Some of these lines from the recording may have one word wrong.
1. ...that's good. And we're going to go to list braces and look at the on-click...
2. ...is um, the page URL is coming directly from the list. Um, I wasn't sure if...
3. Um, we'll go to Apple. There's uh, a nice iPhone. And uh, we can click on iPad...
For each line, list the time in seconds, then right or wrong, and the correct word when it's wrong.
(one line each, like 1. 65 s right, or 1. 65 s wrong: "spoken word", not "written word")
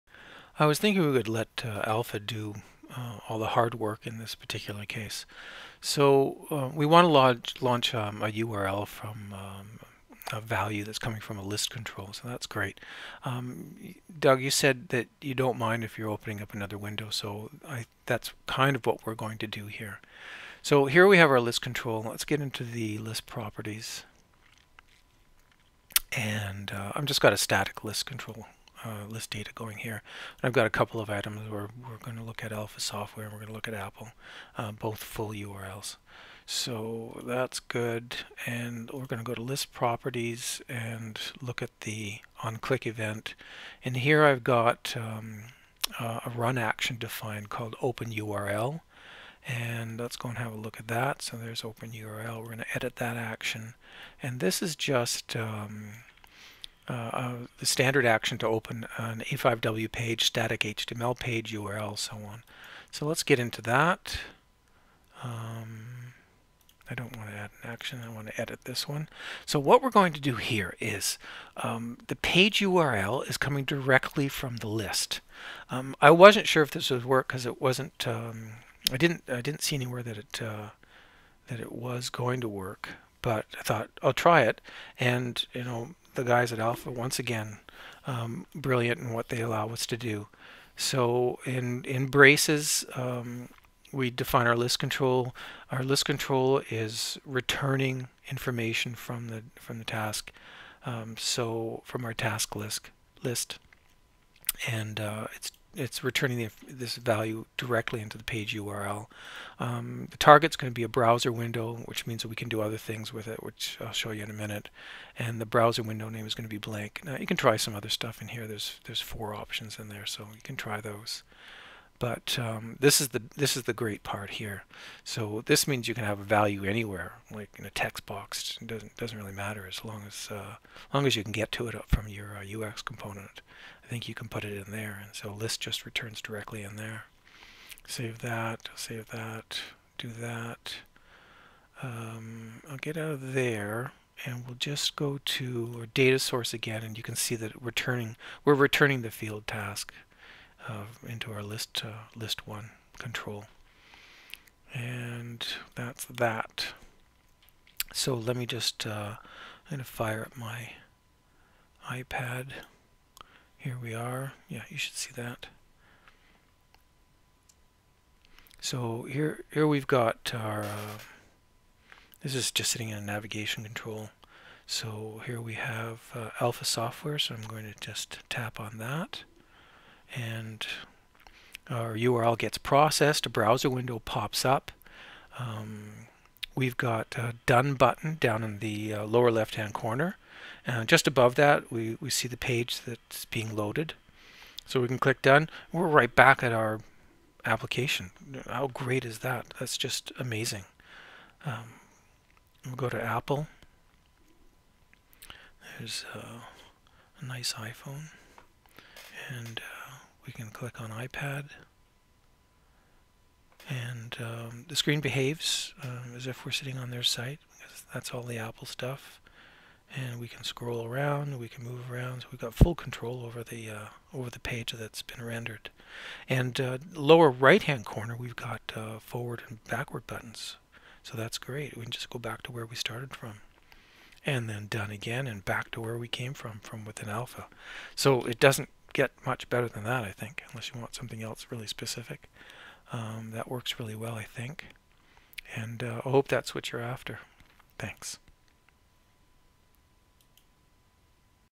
1. 37 s wrong: "properties", not "braces"
2. 70 s right
3. 201 s right.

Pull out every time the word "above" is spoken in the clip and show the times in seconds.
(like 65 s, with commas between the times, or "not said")
191 s.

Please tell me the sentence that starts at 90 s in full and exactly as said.
So in in braces, um, we define our list control.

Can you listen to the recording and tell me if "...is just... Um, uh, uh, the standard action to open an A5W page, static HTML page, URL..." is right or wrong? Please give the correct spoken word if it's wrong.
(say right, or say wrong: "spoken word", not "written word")
right.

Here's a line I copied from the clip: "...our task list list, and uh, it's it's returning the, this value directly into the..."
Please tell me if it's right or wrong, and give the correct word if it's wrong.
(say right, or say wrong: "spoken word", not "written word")
right.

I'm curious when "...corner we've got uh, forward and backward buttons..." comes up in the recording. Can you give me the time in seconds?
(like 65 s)
227 s.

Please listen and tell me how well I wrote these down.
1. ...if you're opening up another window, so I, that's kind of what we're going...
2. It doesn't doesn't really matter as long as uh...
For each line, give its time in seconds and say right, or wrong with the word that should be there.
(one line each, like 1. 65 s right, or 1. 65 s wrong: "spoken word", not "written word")
1. 15 s right
2. 128 s right.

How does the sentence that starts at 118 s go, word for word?
There's there's four options in there, so you can try those.